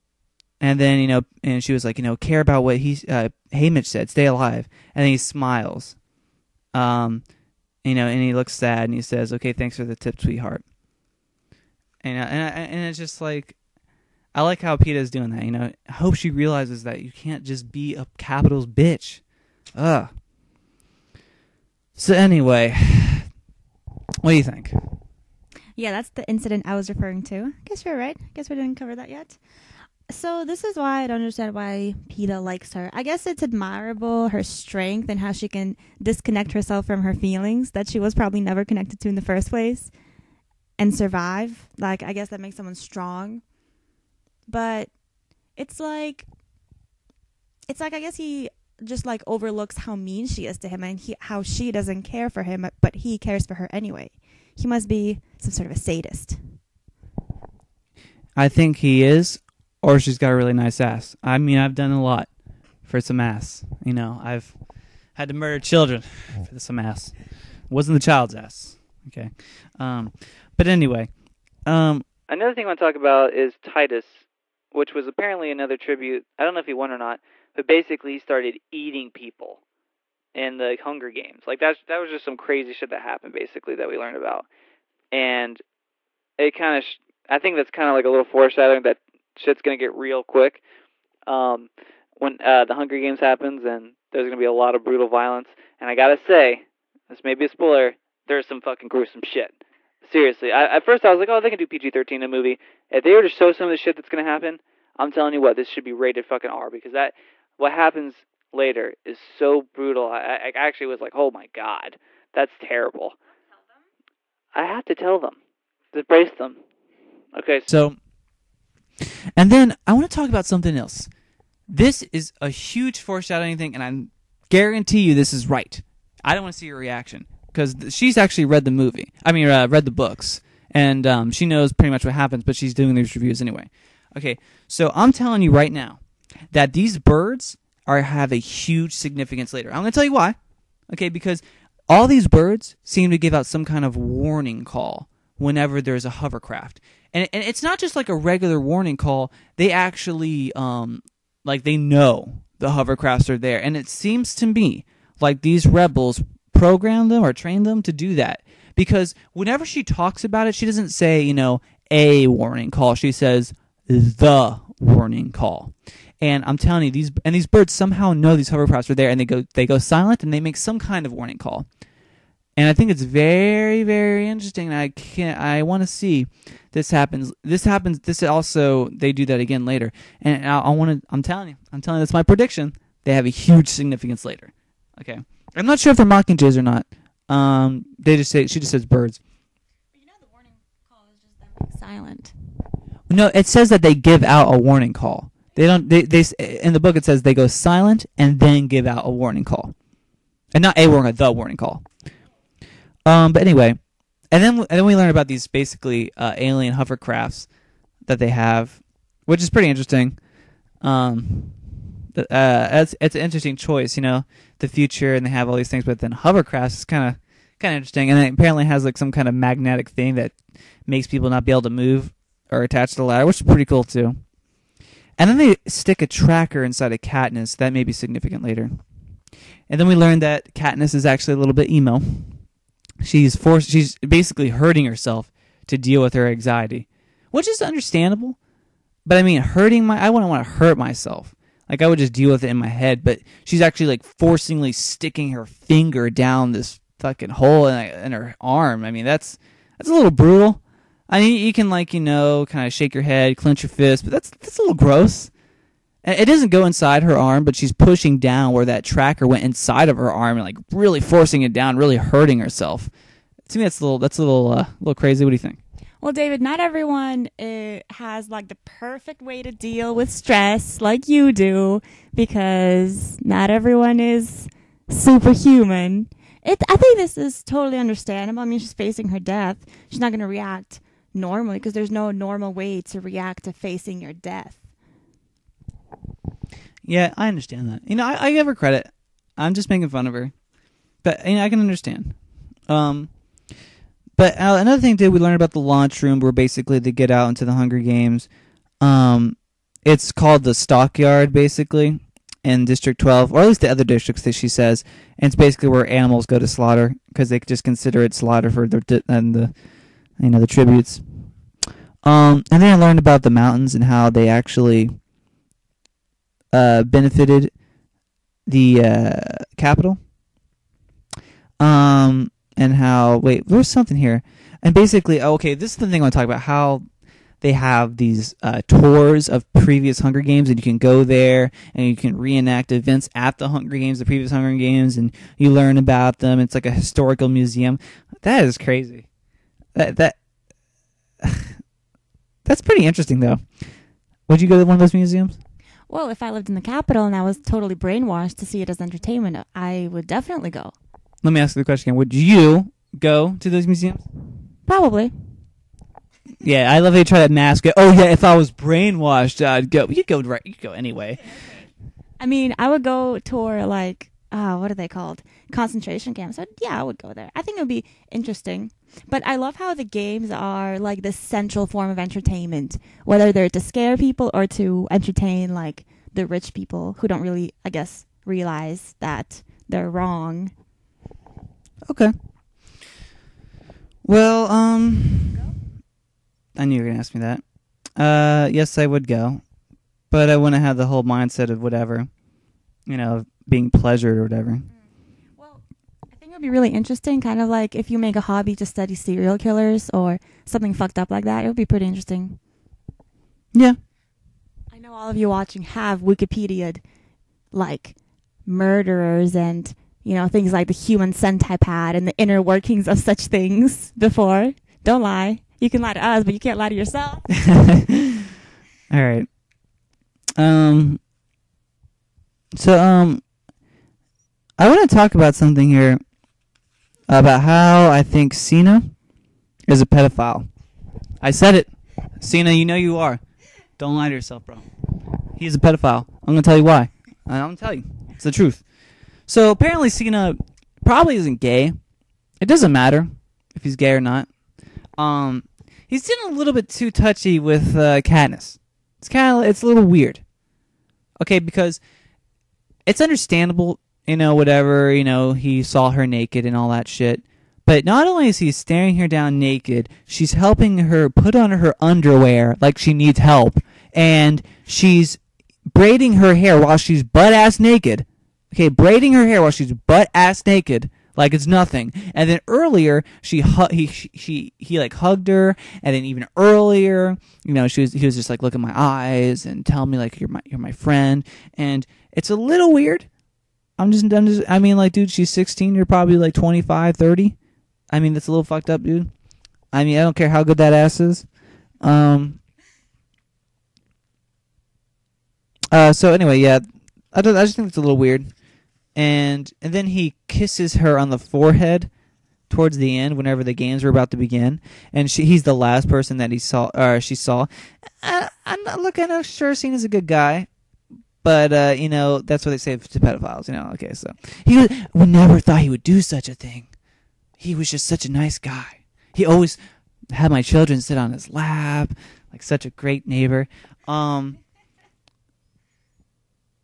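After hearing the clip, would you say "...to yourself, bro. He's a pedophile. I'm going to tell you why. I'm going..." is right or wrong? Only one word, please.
right.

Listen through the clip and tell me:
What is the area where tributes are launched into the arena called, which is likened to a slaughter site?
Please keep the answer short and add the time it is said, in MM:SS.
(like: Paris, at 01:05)
the stockyard, at 05:00.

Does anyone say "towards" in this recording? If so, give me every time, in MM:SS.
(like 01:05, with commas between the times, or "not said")
08:22.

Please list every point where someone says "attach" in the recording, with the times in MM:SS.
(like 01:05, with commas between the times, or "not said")
03:42.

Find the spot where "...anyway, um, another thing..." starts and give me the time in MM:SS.
01:10.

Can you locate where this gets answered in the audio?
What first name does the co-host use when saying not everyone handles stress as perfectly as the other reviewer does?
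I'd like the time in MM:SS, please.
04:26.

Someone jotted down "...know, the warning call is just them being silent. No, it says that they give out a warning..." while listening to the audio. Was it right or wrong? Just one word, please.
right.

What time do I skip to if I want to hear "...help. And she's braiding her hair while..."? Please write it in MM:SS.
07:43.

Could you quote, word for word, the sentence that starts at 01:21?
Like that's that was just some crazy shit that happened basically that we learned about.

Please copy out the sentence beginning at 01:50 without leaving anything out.
I, I actually was like, oh my god, that's terrible.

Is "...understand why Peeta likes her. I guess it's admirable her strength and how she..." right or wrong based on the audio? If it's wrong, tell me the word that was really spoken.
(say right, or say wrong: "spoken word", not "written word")
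right.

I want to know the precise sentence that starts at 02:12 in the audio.
But she's doing these reviews anyway.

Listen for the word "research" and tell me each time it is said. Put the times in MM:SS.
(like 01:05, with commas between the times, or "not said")
not said.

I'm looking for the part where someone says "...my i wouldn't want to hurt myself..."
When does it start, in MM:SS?
03:59.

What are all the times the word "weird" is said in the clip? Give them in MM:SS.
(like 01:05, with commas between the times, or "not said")
07:29, 08:02, 08:17.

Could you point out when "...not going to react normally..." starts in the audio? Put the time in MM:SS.
04:39.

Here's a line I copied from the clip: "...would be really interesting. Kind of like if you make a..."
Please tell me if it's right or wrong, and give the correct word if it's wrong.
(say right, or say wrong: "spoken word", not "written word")
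right.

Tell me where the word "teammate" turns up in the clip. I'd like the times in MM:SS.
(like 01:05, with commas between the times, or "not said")
not said.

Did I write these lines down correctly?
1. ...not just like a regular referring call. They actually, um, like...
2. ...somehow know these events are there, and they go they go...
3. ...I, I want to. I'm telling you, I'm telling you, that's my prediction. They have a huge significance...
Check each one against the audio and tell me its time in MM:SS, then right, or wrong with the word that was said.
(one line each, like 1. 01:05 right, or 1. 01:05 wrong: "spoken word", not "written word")
1. 02:27 wrong: "warning", not "referring"
2. 02:47 wrong: "hovercrafts", not "events"
3. 03:00 right.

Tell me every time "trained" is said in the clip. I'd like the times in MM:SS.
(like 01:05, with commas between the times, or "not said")
02:37.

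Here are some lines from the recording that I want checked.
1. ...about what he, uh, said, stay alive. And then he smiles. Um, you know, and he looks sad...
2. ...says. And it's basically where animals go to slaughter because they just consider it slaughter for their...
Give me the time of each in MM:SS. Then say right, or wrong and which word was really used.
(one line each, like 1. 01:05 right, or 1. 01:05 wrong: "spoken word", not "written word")
1. 00:02 right
2. 05:04 right.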